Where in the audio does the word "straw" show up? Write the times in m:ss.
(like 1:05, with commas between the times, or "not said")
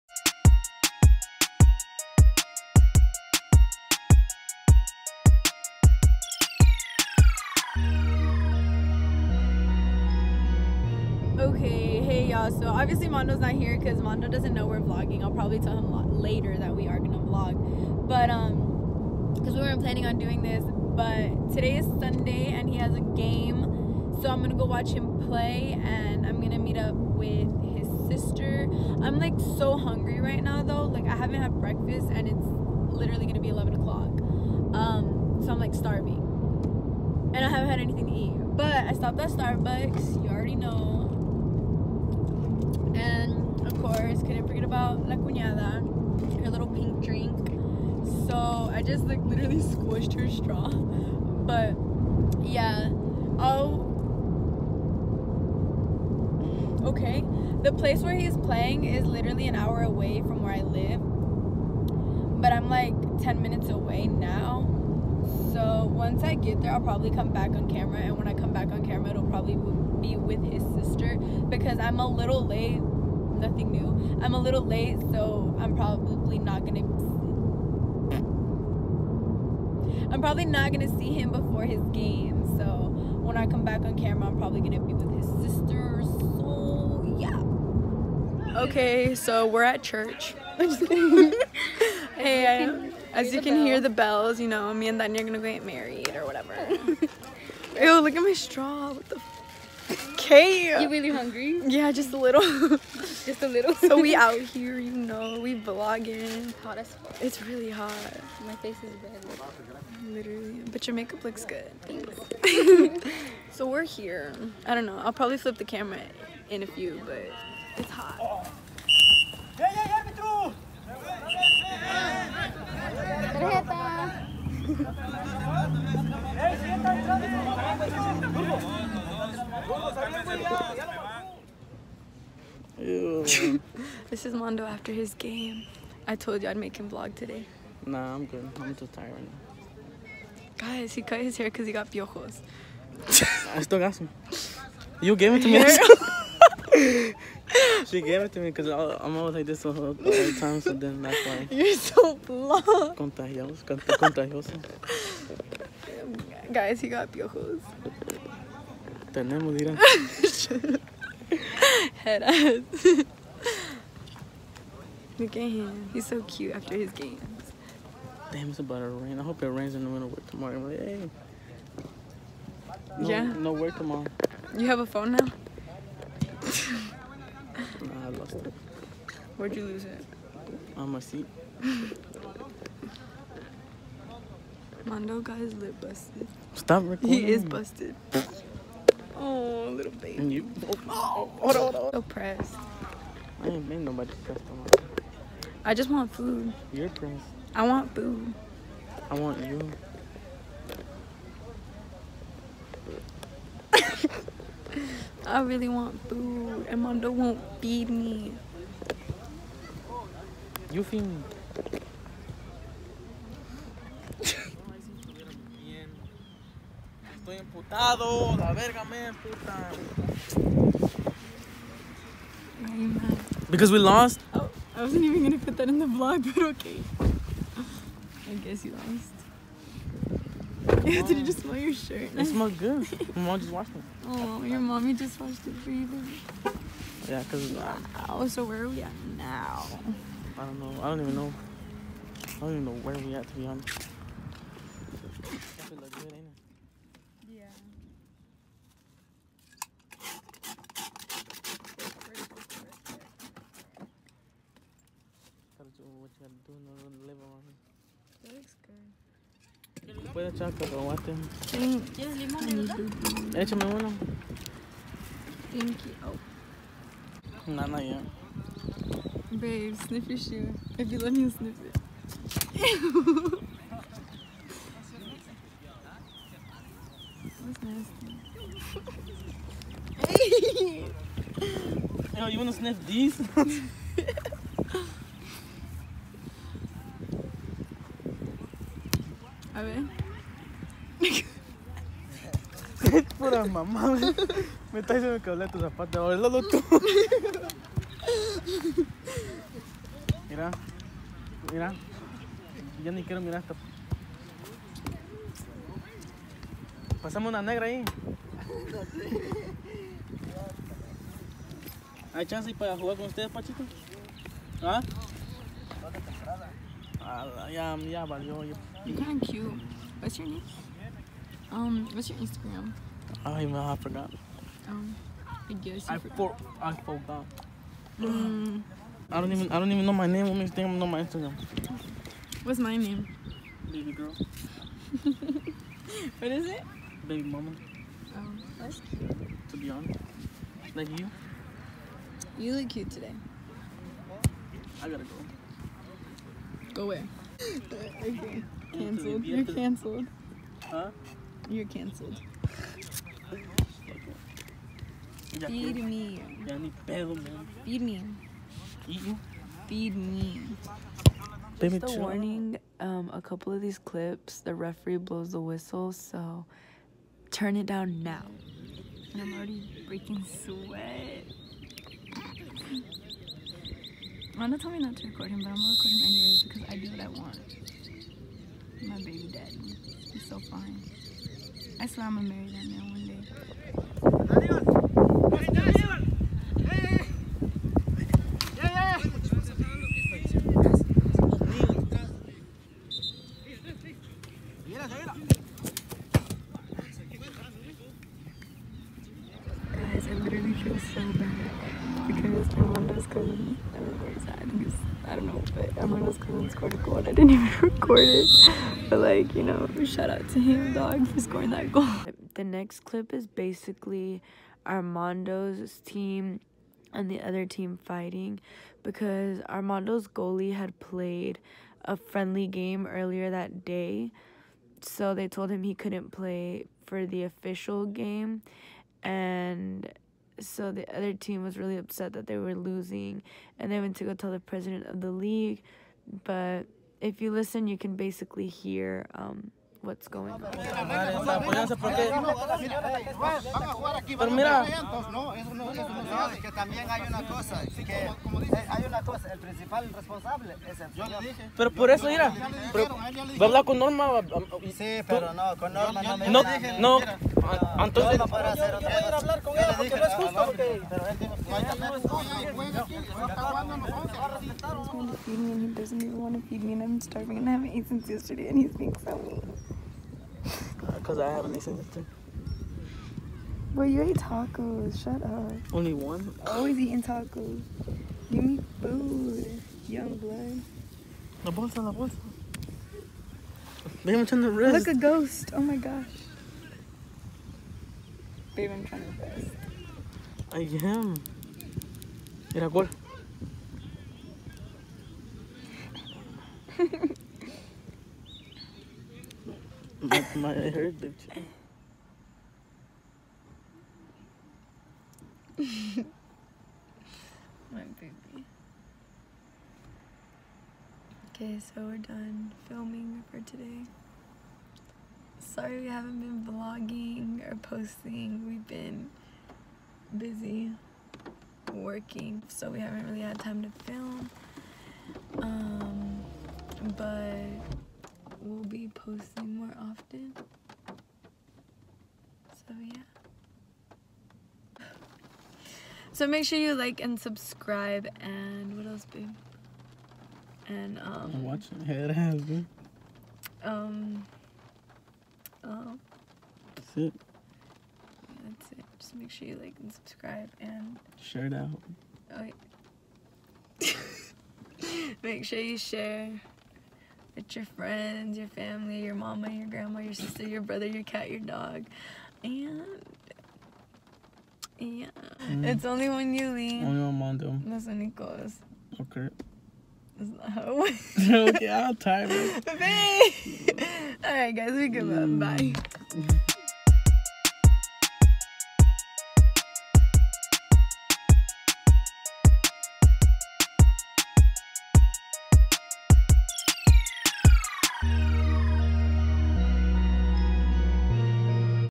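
0:50, 1:38.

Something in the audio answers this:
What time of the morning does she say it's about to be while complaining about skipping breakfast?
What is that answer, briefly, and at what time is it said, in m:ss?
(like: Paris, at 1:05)
11 o'clock, at 0:33.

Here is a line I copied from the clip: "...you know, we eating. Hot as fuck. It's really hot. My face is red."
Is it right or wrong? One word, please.
wrong.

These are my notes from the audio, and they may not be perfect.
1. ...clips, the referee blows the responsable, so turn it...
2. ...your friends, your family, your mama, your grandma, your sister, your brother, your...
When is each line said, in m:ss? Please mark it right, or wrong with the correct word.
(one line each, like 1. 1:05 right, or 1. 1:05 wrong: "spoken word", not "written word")
1. 6:03 wrong: "whistle", not "responsable"
2. 9:17 right.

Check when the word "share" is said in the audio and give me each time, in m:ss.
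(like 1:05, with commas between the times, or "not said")
9:11, 9:15.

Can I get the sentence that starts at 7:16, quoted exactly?
But if you listen, you can basically hear um, what's going on.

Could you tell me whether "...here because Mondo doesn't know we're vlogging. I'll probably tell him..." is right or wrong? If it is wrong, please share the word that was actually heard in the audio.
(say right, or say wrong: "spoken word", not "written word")
right.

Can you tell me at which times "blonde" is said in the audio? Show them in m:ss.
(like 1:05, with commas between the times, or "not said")
2:32.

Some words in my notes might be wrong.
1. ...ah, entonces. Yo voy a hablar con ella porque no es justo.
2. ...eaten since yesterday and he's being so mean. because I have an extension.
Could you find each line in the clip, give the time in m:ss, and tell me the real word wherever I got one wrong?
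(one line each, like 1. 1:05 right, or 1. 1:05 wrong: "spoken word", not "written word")
1. 7:37 right
2. 7:47 right.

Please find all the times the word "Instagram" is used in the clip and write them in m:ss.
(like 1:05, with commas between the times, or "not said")
5:22, 5:31.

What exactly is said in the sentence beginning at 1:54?
I'll probably flip the camera in a few, but it's hot.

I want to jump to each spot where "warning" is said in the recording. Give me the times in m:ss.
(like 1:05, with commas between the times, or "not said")
6:01.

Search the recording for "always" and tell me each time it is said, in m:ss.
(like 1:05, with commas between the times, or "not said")
2:29, 7:56.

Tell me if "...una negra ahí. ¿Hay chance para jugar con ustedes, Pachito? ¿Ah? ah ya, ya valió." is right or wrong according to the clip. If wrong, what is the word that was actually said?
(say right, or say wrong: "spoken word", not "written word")
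right.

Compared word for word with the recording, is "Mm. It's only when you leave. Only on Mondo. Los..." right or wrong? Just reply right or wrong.
right.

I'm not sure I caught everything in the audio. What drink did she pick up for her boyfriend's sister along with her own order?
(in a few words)
Pink drink.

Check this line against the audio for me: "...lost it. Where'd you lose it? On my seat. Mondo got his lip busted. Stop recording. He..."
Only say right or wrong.
right.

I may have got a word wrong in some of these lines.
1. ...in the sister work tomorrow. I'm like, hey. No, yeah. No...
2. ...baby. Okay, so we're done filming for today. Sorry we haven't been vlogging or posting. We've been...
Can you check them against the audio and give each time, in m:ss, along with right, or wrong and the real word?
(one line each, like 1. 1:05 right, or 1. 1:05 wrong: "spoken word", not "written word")
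1. 2:49 wrong: "winter", not "sister"
2. 8:27 right.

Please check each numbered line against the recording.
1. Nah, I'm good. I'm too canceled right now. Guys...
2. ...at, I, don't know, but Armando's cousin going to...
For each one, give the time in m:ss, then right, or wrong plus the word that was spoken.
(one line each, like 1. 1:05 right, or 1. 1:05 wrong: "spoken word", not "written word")
1. 2:17 wrong: "tired", not "canceled"
2. 6:44 right.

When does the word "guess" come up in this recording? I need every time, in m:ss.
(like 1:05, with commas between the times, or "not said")
3:48, 5:25.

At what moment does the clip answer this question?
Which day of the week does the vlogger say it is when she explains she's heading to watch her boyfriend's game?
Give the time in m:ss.
0:21.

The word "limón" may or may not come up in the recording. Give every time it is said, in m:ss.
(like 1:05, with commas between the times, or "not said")
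4:22.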